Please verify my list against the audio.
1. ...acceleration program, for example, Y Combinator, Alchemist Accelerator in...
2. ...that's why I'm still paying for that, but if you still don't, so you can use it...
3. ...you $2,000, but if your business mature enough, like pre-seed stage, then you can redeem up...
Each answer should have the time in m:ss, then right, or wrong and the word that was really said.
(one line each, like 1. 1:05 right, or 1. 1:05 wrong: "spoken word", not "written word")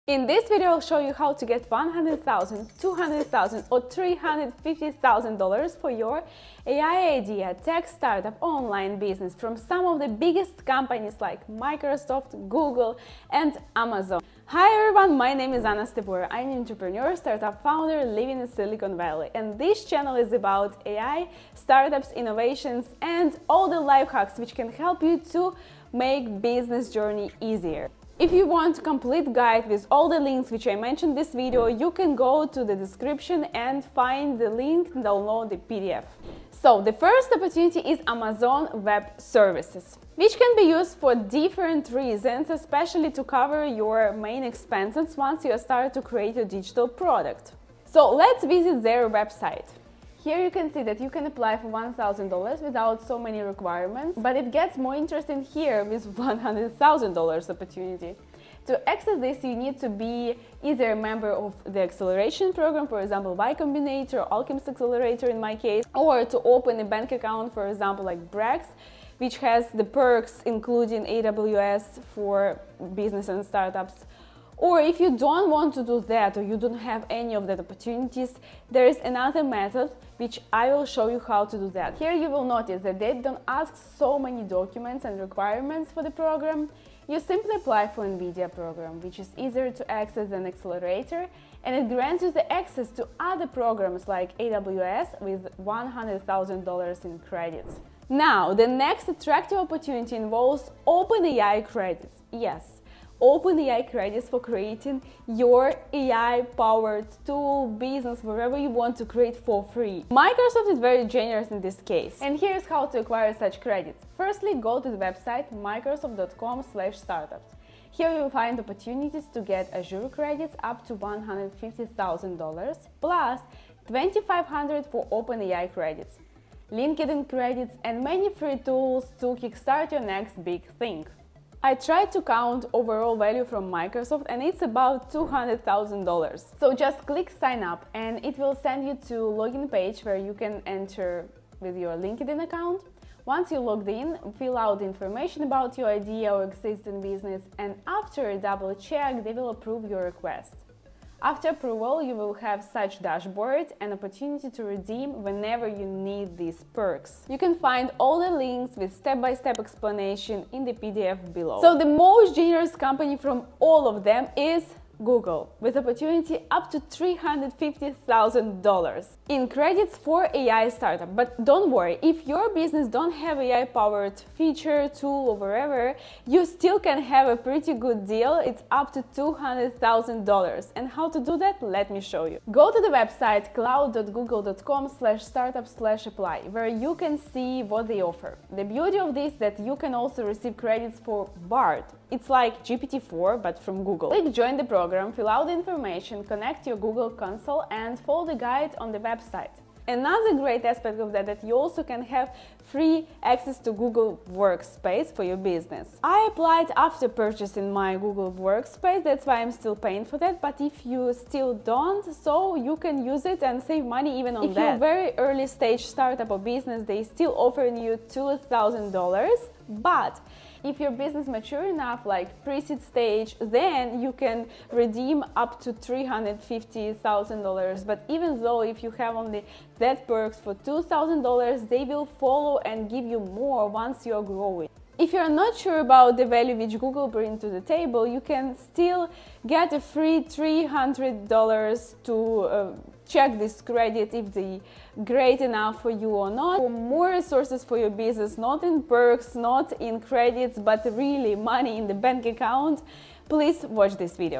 1. 1:01 right
2. 3:29 right
3. 3:37 right.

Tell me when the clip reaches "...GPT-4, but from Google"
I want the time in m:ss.
3:12.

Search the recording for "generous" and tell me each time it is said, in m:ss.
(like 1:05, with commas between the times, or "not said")
1:51, 2:42.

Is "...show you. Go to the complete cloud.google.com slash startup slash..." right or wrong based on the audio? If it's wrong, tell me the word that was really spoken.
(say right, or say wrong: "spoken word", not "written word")
wrong: "website", not "complete".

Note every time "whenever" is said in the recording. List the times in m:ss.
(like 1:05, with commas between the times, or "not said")
2:35.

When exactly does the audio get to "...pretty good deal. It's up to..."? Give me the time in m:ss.
2:57.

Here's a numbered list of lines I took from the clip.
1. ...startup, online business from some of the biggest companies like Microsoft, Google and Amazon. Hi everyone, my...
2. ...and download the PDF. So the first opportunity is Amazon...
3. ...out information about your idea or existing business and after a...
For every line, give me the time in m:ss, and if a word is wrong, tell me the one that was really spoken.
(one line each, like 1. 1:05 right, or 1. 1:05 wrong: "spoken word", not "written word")
1. 0:07 right
2. 0:34 right
3. 2:24 right.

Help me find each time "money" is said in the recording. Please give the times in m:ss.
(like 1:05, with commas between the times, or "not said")
3:33, 4:11.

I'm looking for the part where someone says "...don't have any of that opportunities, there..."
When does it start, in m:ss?
1:16.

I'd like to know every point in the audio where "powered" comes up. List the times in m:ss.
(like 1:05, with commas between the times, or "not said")
1:45, 2:53.